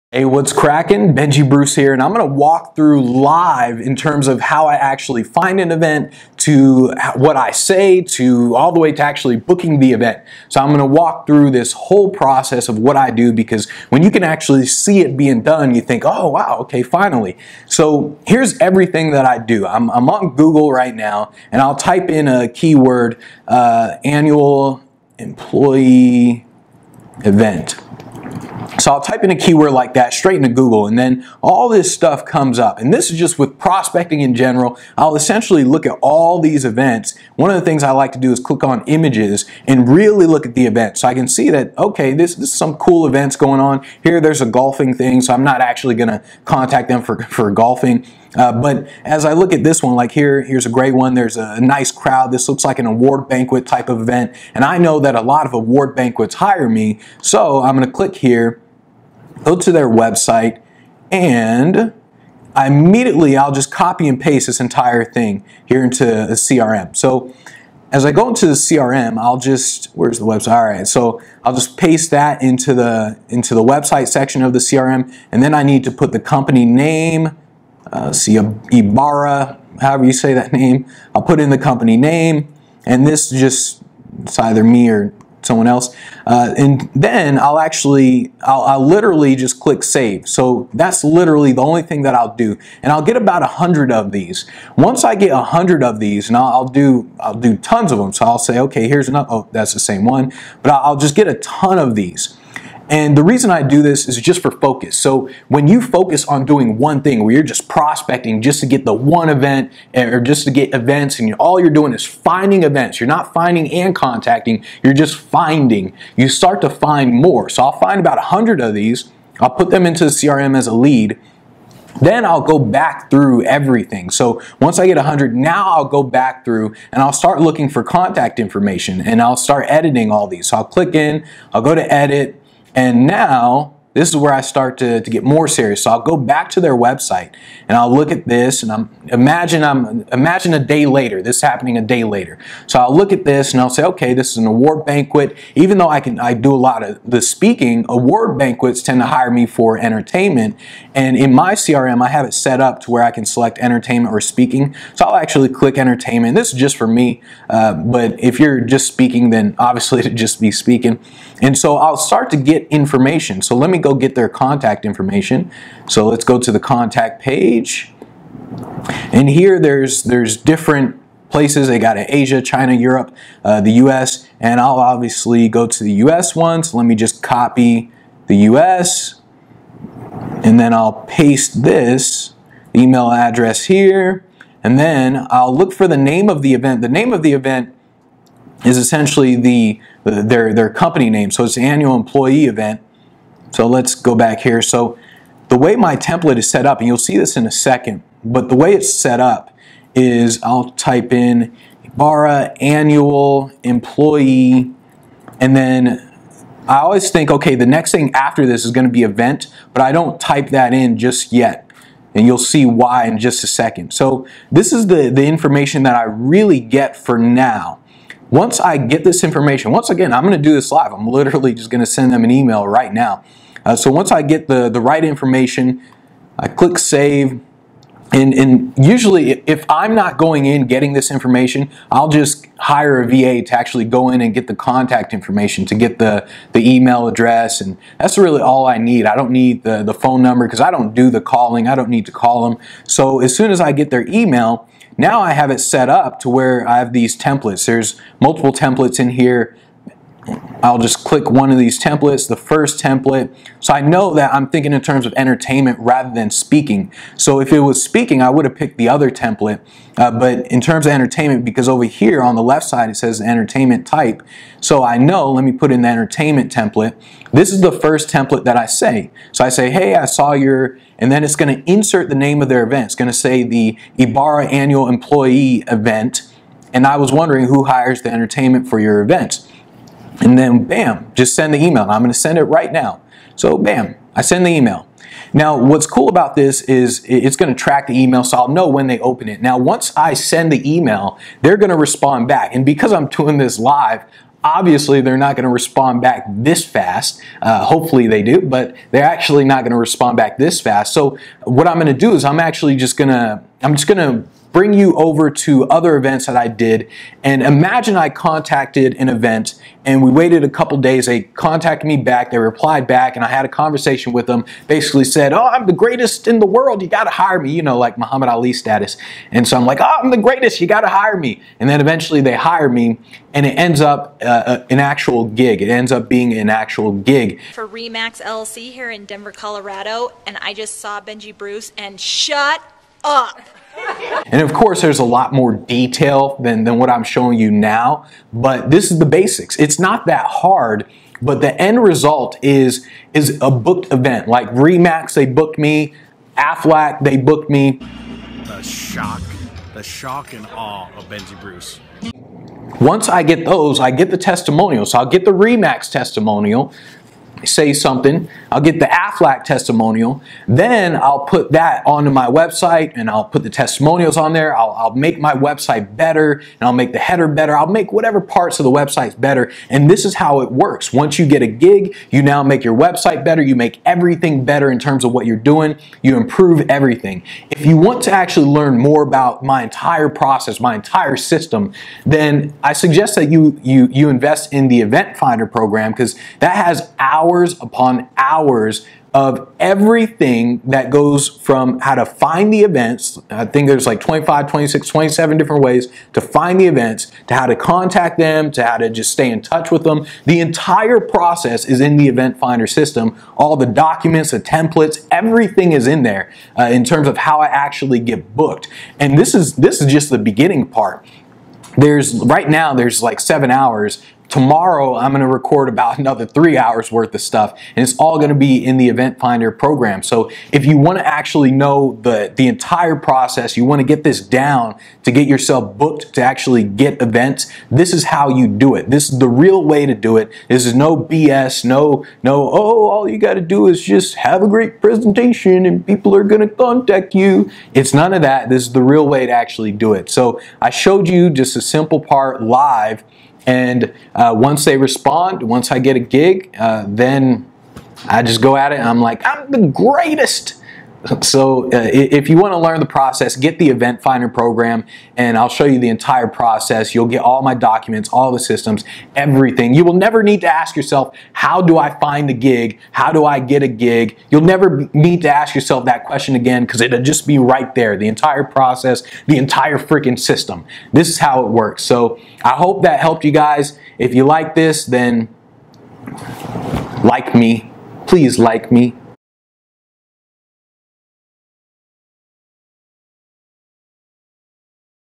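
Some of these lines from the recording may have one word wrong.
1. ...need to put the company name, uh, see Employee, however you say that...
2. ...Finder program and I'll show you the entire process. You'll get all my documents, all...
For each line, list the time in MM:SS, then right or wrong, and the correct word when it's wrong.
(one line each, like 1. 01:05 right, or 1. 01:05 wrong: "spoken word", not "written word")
1. 01:15 wrong: "Ibarra", not "Employee"
2. 07:34 right.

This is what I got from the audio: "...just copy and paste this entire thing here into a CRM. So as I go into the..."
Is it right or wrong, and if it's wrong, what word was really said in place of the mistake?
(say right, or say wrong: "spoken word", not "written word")
right.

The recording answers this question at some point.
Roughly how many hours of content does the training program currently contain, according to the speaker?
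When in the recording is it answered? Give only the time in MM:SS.
06:53.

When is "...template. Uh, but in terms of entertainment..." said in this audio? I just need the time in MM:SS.
04:19.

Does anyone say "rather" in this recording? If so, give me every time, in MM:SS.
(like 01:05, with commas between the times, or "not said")
04:15.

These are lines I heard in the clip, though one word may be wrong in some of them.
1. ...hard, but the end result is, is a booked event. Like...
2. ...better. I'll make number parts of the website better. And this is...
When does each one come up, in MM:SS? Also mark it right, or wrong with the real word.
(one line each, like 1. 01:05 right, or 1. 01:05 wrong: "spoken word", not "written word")
1. 05:40 right
2. 06:07 wrong: "whatever", not "number".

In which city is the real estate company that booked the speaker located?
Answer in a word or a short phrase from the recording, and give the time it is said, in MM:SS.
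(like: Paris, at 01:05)
Denver, Colorado, at 05:29.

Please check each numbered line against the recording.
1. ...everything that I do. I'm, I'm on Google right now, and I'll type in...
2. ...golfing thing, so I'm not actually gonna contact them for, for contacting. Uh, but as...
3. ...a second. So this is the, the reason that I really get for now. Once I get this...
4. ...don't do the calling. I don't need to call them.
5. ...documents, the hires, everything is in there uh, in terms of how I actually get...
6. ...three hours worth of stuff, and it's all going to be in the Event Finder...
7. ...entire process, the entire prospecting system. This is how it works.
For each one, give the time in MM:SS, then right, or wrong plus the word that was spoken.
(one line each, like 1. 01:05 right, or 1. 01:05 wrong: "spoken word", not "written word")
1. 00:18 right
2. 00:44 wrong: "golfing", not "contacting"
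3. 03:33 wrong: "information", not "reason"
4. 04:00 right
5. 06:43 wrong: "templates", not "hires"
6. 06:56 right
7. 07:48 wrong: "freaking", not "prospecting".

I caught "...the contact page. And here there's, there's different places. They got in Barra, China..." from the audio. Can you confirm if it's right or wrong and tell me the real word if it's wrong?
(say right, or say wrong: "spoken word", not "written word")
wrong: "Asia", not "Barra".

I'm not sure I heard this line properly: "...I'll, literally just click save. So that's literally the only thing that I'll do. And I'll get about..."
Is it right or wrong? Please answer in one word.
right.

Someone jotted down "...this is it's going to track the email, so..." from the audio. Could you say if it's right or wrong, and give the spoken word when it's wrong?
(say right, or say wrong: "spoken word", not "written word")
right.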